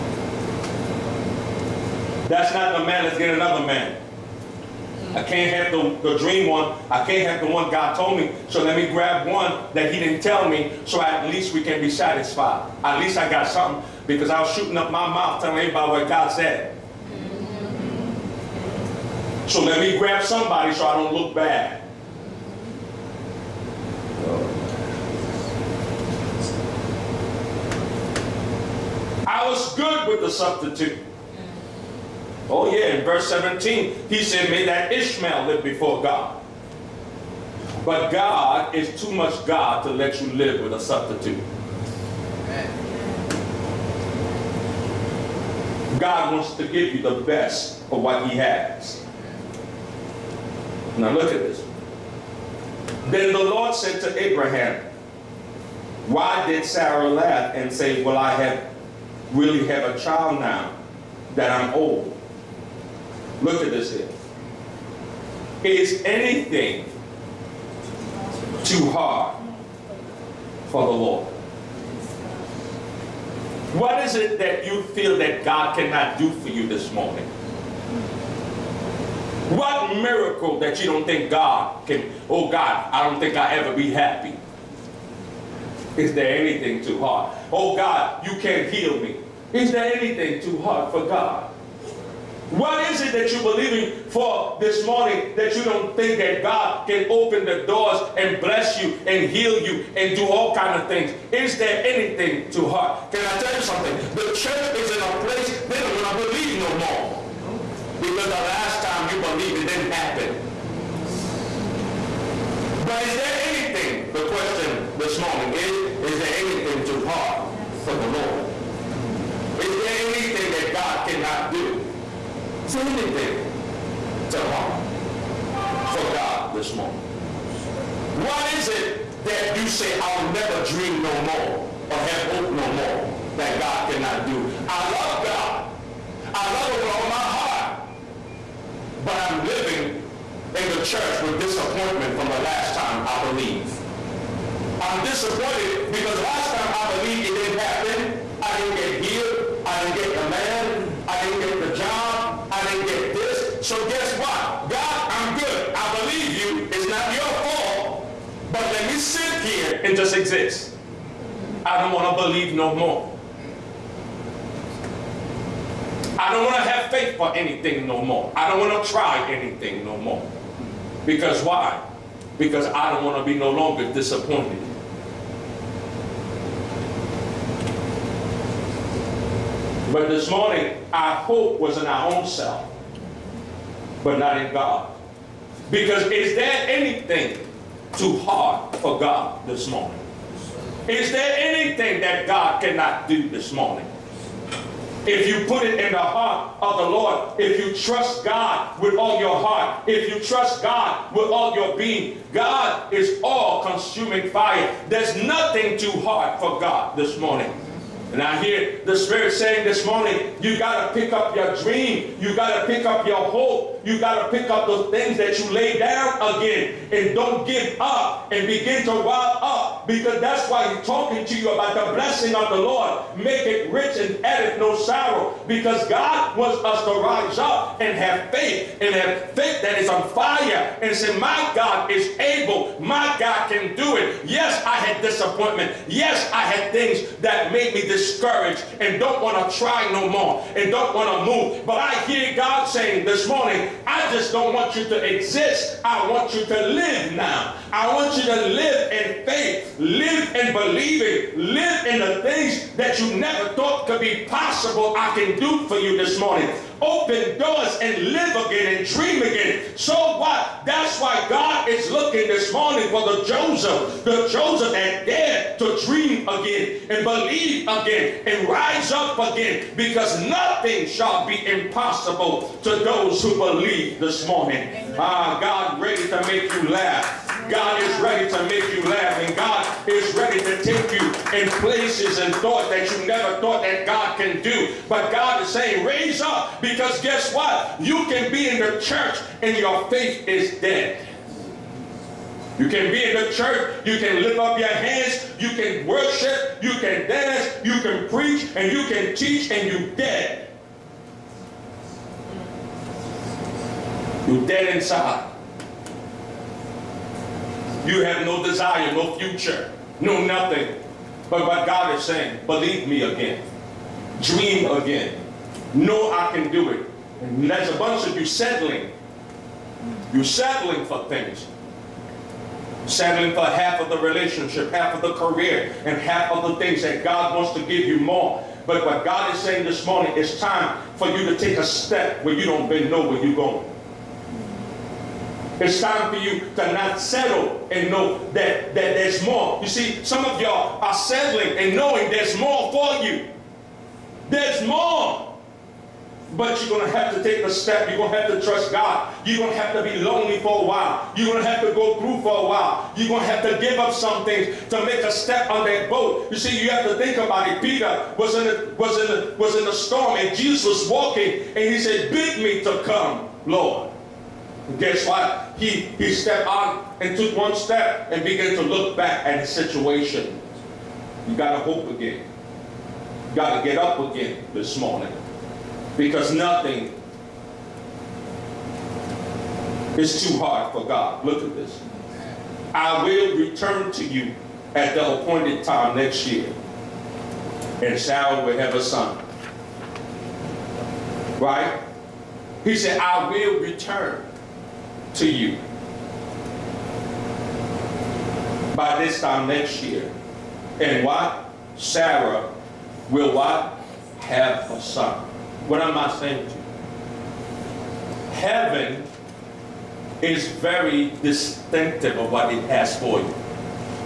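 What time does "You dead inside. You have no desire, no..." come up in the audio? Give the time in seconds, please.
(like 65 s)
304 s.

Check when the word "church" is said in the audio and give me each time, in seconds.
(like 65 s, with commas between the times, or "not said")
104 s, 140 s, 288 s, 293 s.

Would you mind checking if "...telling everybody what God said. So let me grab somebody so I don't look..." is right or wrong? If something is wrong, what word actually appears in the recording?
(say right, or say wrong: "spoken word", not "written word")
right.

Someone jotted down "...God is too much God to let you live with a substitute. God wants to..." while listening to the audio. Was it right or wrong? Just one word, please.
right.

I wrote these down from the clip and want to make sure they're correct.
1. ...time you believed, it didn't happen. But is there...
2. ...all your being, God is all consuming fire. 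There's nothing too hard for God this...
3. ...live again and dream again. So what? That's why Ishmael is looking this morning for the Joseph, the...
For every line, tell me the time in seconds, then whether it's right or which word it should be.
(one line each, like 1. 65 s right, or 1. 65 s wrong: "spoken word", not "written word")
1. 108 s right
2. 201 s right
3. 258 s wrong: "God", not "Ishmael".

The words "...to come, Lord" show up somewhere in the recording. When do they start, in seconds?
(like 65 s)
362 s.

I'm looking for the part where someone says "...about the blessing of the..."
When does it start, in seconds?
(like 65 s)
221 s.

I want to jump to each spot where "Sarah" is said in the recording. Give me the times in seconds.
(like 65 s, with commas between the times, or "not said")
56 s, 387 s, 401 s.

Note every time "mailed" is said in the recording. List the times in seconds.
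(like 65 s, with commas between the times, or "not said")
not said.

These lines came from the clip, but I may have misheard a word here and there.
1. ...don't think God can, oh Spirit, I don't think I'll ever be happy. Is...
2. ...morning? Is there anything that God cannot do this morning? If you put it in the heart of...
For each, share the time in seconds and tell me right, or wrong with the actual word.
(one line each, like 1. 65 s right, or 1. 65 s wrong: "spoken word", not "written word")
1. 80 s wrong: "God", not "Spirit"
2. 189 s right.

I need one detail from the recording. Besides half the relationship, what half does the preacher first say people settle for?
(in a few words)
career.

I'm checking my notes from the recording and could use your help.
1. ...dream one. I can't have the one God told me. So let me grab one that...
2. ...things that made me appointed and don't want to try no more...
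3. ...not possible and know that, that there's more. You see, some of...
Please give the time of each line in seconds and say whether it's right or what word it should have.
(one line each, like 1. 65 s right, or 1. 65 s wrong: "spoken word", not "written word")
1. 6 s right
2. 236 s wrong: "discouraged", not "appointed"
3. 336 s wrong: "settle", not "possible".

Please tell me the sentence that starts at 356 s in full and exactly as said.
You see, you have to think about it.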